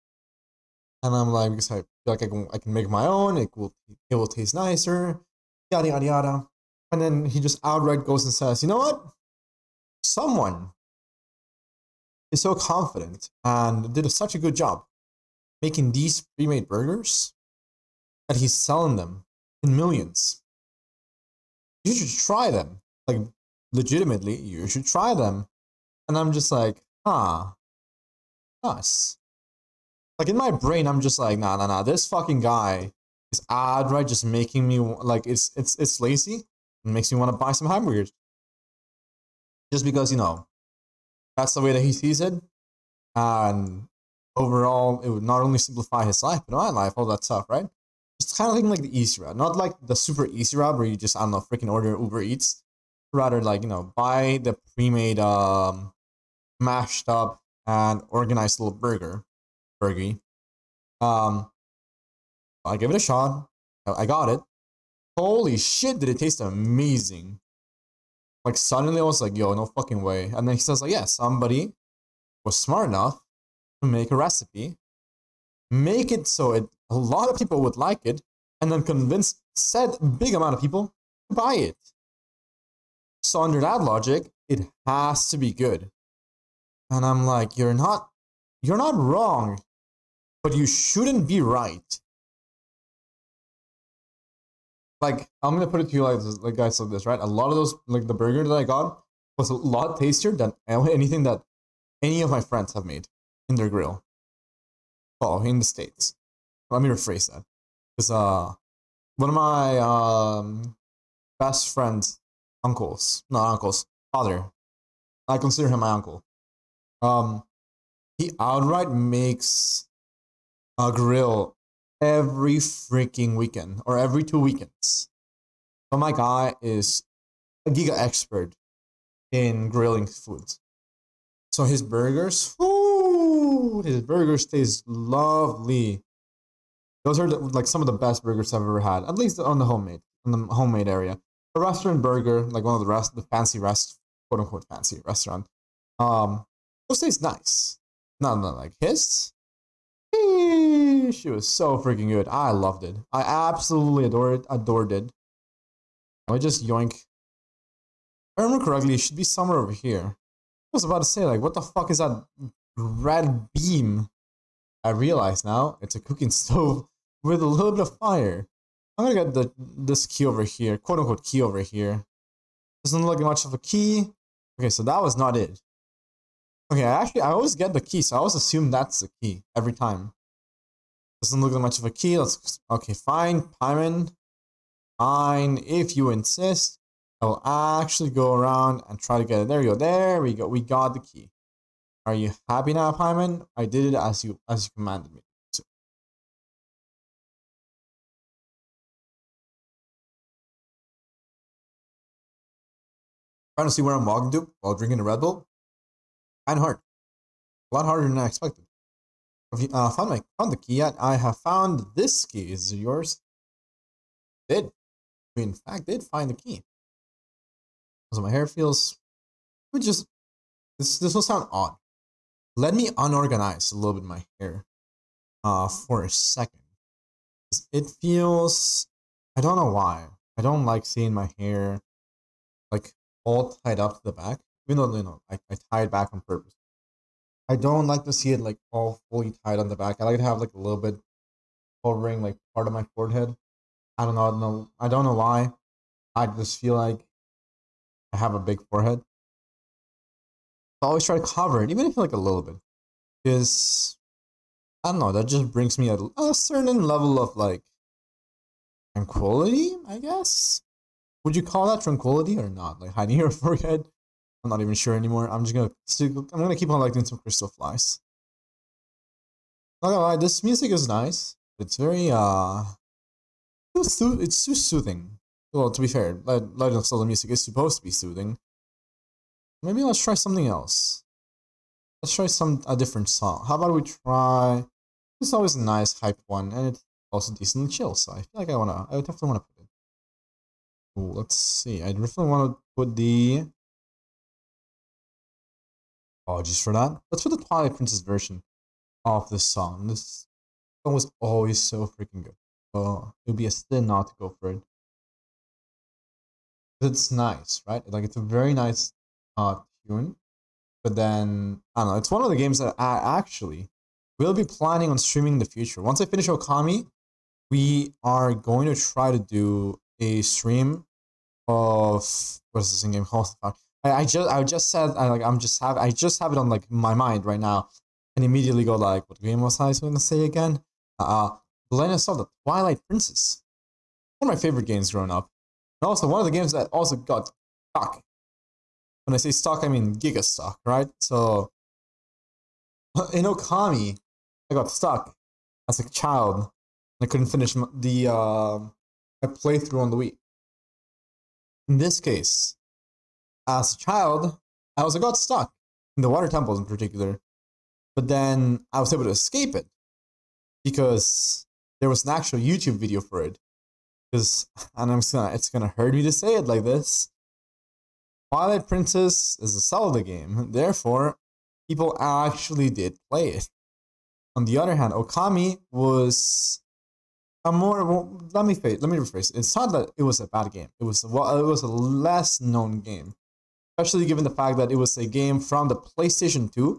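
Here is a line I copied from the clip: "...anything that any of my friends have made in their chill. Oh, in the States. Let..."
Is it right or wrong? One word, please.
wrong.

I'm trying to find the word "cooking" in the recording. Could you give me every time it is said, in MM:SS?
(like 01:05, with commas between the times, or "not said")
02:45.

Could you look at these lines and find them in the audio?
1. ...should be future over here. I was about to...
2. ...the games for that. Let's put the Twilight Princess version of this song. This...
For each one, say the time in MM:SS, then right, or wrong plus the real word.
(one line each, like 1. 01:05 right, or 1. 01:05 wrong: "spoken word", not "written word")
1. 02:38 wrong: "somewhere", not "future"
2. 04:52 wrong: "apologies", not "games".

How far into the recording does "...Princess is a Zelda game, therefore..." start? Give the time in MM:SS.
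06:08.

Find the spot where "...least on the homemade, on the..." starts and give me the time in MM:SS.
02:19.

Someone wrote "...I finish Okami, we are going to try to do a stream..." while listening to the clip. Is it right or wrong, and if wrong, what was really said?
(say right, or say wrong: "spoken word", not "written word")
right.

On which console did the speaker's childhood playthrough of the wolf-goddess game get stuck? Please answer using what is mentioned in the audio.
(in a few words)
Wii.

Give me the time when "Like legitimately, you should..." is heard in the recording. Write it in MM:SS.
00:23.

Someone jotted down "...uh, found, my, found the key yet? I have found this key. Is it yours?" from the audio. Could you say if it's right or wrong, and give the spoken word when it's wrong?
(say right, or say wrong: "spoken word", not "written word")
right.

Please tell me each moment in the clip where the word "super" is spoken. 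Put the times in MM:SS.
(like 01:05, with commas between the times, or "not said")
00:49.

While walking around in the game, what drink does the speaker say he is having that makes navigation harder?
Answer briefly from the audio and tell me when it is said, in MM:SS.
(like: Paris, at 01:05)
Red Bull, at 03:25.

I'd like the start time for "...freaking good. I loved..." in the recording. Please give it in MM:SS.
02:31.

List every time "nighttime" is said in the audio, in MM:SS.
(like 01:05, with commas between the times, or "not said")
not said.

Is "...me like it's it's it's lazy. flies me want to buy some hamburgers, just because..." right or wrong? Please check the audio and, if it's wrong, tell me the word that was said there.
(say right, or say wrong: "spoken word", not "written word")
wrong: "makes", not "flies".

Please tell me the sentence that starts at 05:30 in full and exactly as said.
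Uh, saw the Twilight Princess, one of my favorite games growing up, and also one of the games that also got stuck.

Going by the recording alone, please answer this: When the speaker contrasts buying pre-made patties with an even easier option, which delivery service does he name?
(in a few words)
Uber Eats.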